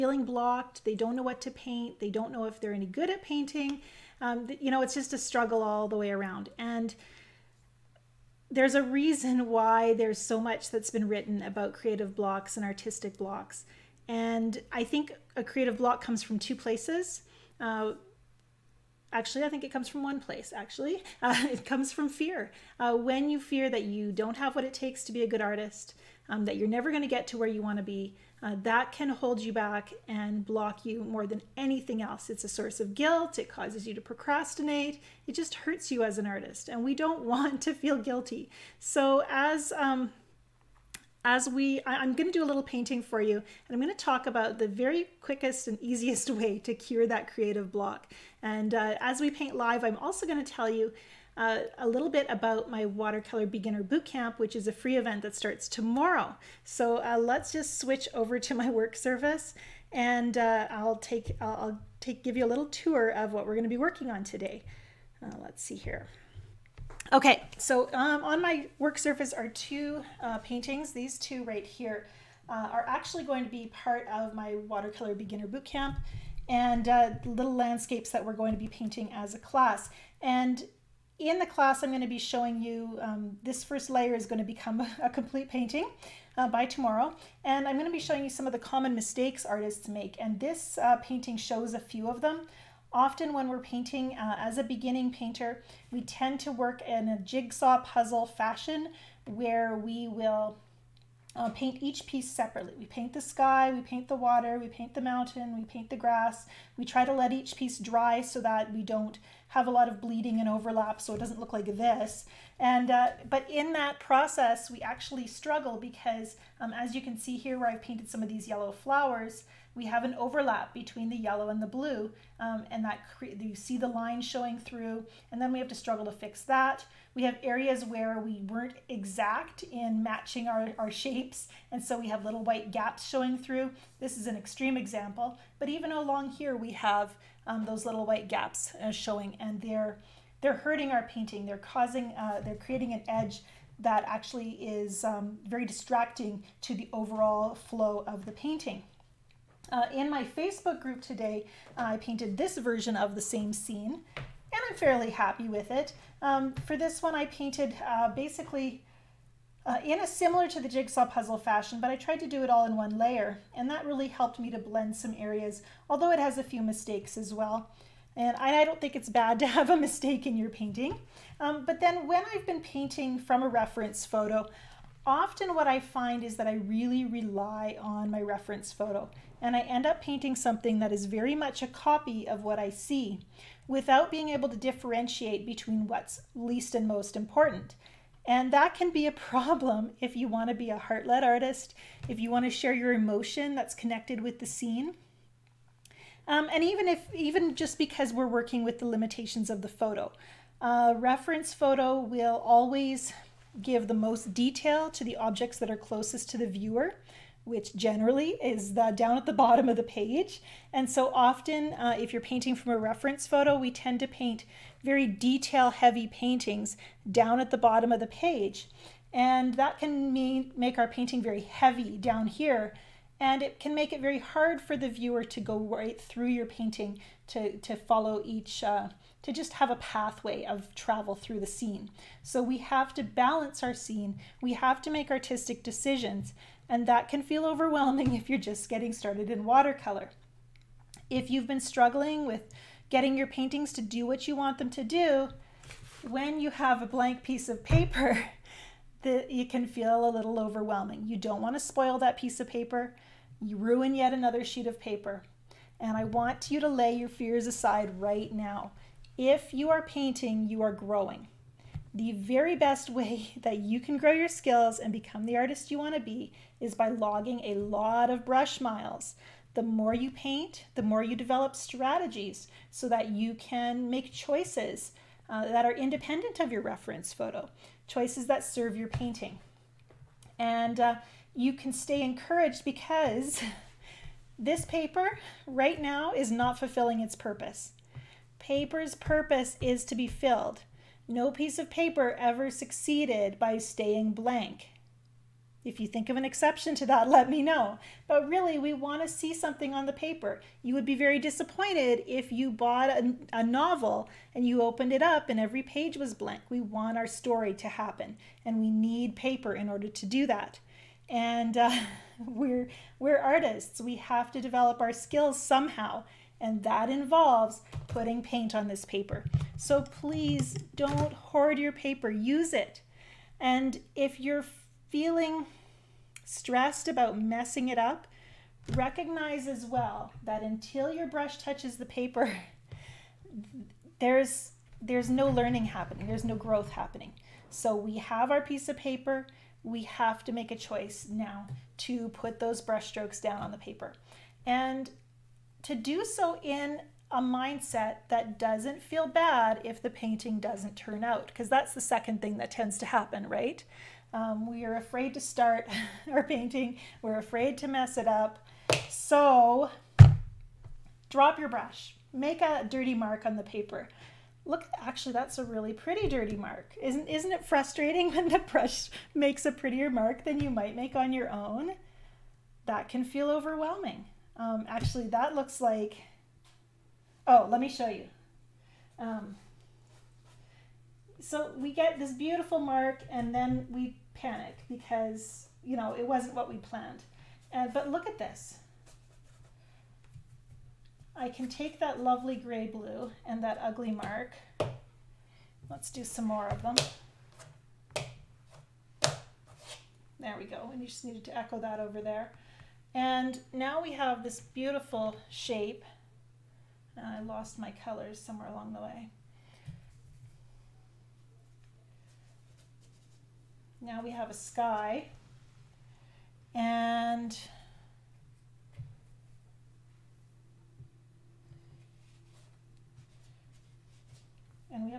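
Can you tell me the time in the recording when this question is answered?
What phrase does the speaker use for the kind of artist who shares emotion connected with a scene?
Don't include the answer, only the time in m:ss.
3:10.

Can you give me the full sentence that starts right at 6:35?
Let's do some more of them.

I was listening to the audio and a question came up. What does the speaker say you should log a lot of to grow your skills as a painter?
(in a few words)
Brush miles.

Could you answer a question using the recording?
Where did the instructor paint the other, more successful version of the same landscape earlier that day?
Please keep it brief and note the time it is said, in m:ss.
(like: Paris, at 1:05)
Facebook group, at 2:30.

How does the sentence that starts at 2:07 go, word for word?
We have areas where we weren't exact in matching our, our shapes, and so we have little white gaps showing through.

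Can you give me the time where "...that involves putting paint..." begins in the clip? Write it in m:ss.
5:16.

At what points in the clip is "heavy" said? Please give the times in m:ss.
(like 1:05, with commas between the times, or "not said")
3:35, 3:41.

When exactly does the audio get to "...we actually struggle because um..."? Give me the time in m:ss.
1:54.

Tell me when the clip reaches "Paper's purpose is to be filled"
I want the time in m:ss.
4:48.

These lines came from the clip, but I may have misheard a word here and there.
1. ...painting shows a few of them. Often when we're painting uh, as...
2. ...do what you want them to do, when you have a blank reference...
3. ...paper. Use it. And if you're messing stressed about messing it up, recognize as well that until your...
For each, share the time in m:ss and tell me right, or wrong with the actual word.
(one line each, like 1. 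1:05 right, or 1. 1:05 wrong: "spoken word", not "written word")
1. 1:31 right
2. 4:03 wrong: "piece", not "reference"
3. 5:21 wrong: "feeling", not "messing".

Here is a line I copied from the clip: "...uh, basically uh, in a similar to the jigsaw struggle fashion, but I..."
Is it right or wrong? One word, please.
wrong.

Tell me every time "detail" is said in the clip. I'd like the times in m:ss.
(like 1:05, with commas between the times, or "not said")
3:24, 3:35.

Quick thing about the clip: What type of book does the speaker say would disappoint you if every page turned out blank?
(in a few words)
A novel.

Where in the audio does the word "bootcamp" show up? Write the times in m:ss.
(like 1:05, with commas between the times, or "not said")
0:53, 1:15.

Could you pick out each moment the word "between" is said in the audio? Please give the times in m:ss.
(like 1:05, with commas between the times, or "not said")
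2:00, 3:05.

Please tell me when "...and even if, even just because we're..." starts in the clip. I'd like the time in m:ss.
3:16.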